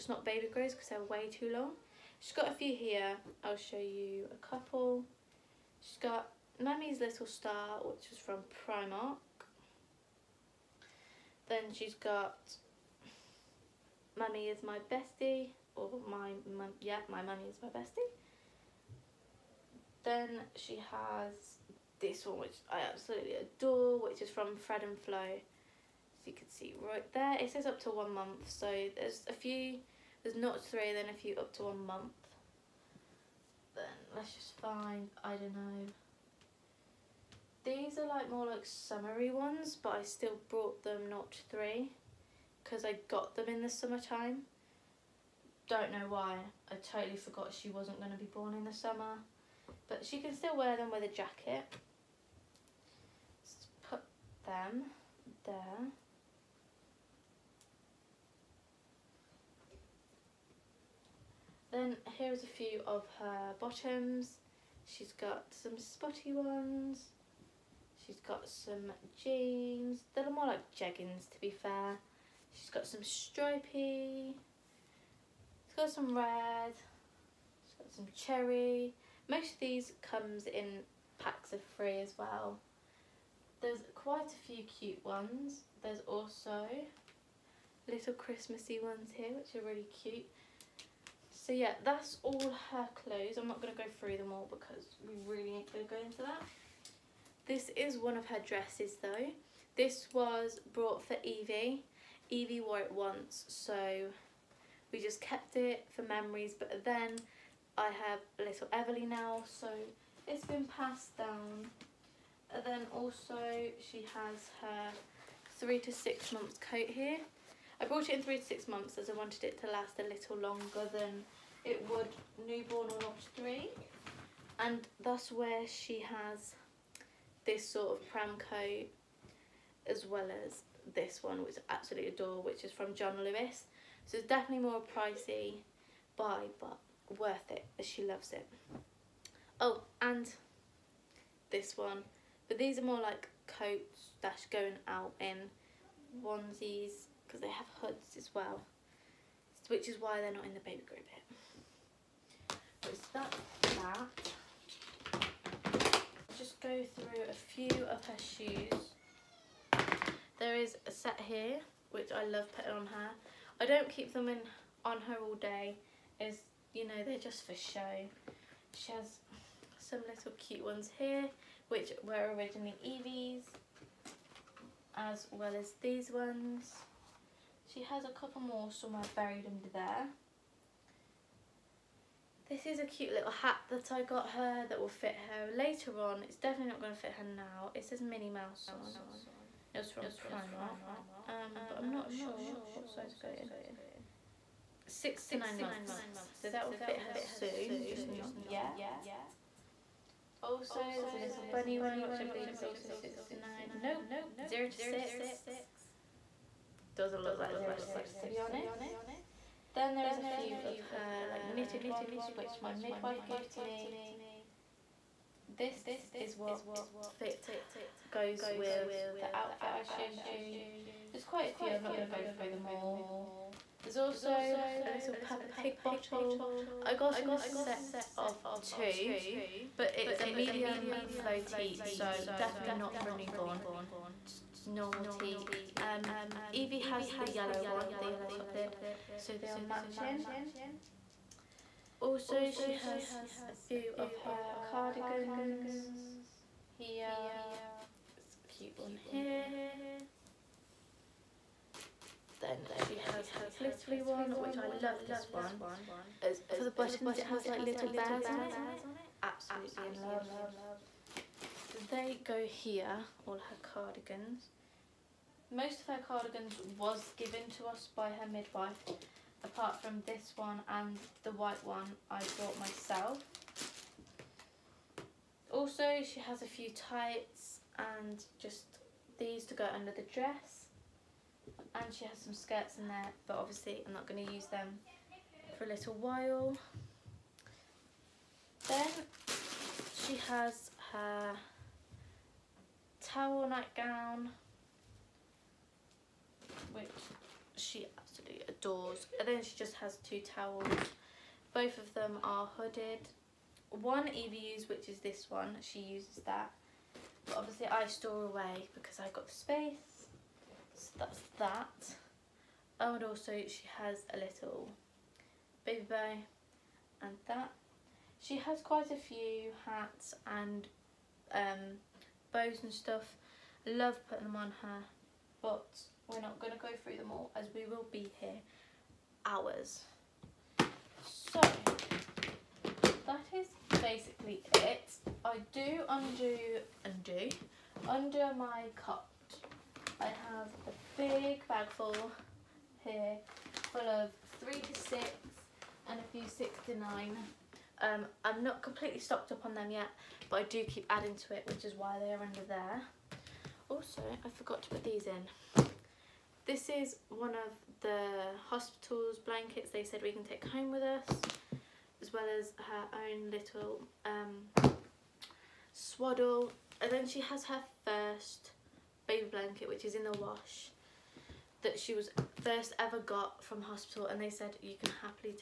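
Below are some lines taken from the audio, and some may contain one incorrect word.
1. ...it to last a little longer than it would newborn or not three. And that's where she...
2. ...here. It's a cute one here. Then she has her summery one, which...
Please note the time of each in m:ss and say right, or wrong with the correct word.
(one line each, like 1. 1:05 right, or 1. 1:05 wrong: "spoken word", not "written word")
1. 1:59 right
2. 4:06 wrong: "glittery", not "summery".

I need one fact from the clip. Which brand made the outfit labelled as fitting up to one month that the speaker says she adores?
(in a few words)
Fred and Flo.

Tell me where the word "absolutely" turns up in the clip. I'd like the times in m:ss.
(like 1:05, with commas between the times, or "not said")
0:22, 2:11, 4:19, 4:57.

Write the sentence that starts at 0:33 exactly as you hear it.
Then let's just find, I don't know.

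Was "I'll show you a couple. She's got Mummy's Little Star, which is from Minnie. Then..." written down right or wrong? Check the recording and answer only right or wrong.
wrong.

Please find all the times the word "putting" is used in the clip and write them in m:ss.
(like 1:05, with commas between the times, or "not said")
2:42, 5:24.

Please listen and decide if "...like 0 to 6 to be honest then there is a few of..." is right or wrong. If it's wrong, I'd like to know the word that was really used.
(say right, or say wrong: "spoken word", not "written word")
right.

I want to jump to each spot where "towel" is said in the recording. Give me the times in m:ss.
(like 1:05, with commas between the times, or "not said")
4:53, 5:00.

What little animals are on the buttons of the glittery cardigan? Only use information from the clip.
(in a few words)
Bears.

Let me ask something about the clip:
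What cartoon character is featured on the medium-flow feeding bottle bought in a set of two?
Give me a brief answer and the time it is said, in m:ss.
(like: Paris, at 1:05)
Peppa Pig, at 3:45.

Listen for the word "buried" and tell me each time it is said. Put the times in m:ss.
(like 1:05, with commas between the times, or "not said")
2:59.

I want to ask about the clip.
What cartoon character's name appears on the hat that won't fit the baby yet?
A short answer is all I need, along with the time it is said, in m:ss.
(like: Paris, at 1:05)
Minnie Mouse, at 3:08.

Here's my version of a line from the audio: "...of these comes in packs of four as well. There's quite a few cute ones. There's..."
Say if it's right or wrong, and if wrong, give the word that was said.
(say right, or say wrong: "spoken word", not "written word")
wrong: "three", not "four".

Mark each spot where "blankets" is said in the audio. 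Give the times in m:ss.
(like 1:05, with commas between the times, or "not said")
5:59, 6:09.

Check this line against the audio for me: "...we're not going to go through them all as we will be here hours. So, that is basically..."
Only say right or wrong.
right.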